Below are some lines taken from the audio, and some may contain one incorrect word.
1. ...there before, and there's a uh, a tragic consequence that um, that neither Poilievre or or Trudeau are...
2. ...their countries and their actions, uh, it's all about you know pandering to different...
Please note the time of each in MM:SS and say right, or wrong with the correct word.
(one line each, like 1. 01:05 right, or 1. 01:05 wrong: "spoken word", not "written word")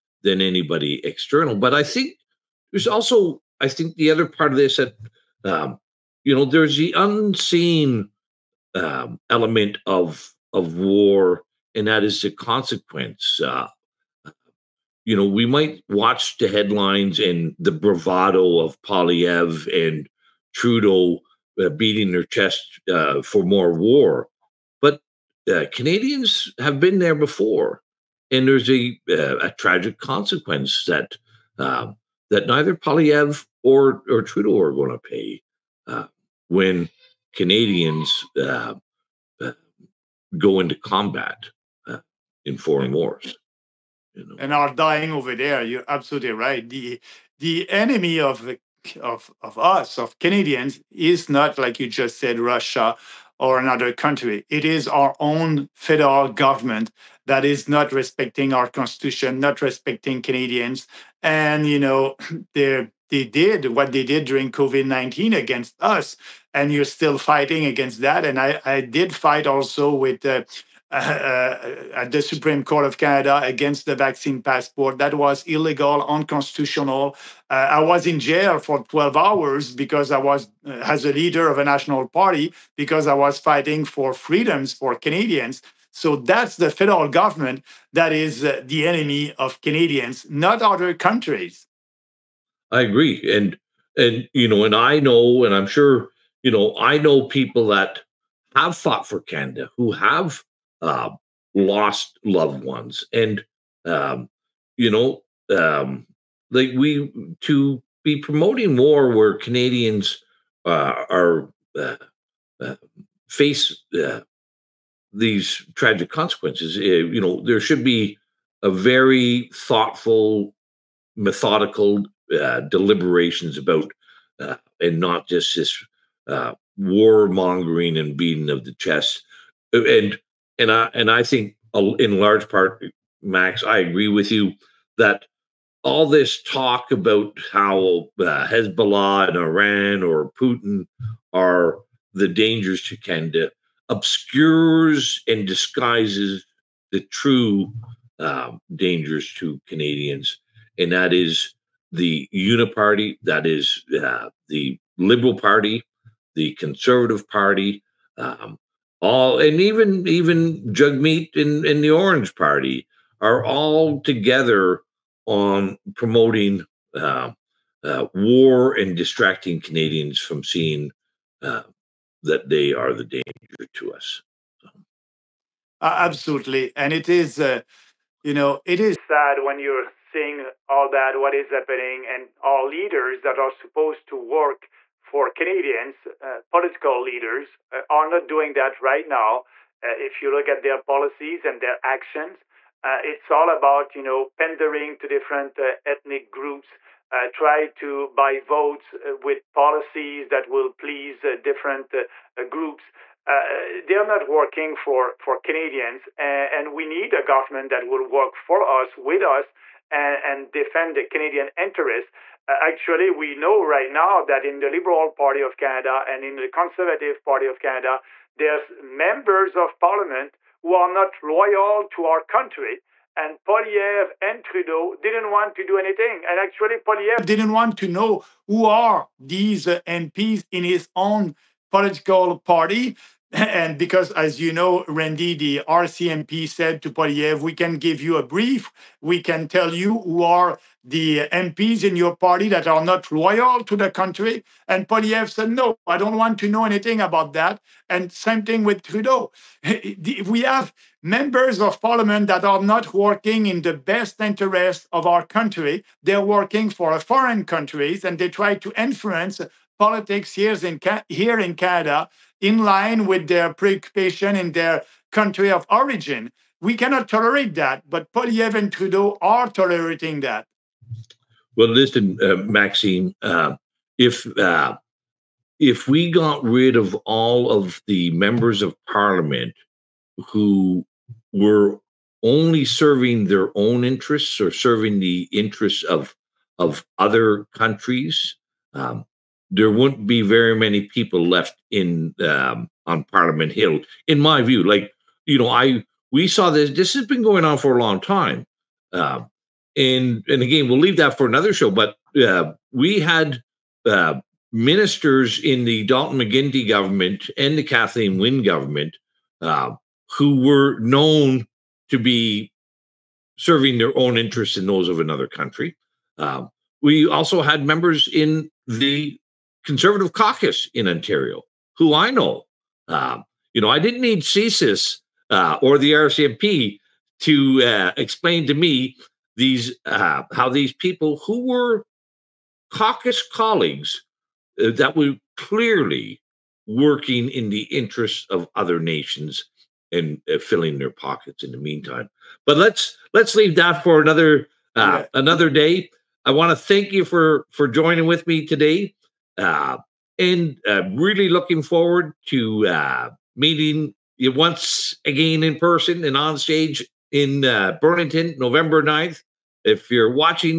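1. 00:26 right
2. 03:10 wrong: "policies", not "countries".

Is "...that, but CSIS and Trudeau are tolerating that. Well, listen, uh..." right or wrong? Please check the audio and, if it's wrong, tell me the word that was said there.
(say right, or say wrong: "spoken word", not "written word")
wrong: "Poilievre", not "CSIS".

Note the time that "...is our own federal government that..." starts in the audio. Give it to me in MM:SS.
00:54.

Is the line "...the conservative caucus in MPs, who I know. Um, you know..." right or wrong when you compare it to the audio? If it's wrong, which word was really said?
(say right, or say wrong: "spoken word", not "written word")
wrong: "Ontario", not "MPs".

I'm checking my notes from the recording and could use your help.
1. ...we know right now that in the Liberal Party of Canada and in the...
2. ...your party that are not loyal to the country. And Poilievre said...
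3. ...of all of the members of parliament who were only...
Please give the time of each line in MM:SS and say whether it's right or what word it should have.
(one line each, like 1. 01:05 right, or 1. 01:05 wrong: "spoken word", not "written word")
1. 03:33 right
2. 04:01 right
3. 04:36 right.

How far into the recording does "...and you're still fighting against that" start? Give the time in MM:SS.
01:06.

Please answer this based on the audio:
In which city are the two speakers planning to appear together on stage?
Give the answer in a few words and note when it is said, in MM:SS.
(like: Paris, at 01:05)
Burlington, at 05:57.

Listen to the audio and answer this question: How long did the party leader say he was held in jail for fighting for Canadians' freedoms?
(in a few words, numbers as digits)
12 hours.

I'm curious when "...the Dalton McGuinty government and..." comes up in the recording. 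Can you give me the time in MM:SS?
05:05.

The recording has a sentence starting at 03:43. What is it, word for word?
And Poilievre and Trudeau didn't want to do anything.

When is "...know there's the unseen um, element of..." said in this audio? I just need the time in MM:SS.
00:06.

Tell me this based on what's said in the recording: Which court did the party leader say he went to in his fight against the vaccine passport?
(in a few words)
Supreme Court of Canada.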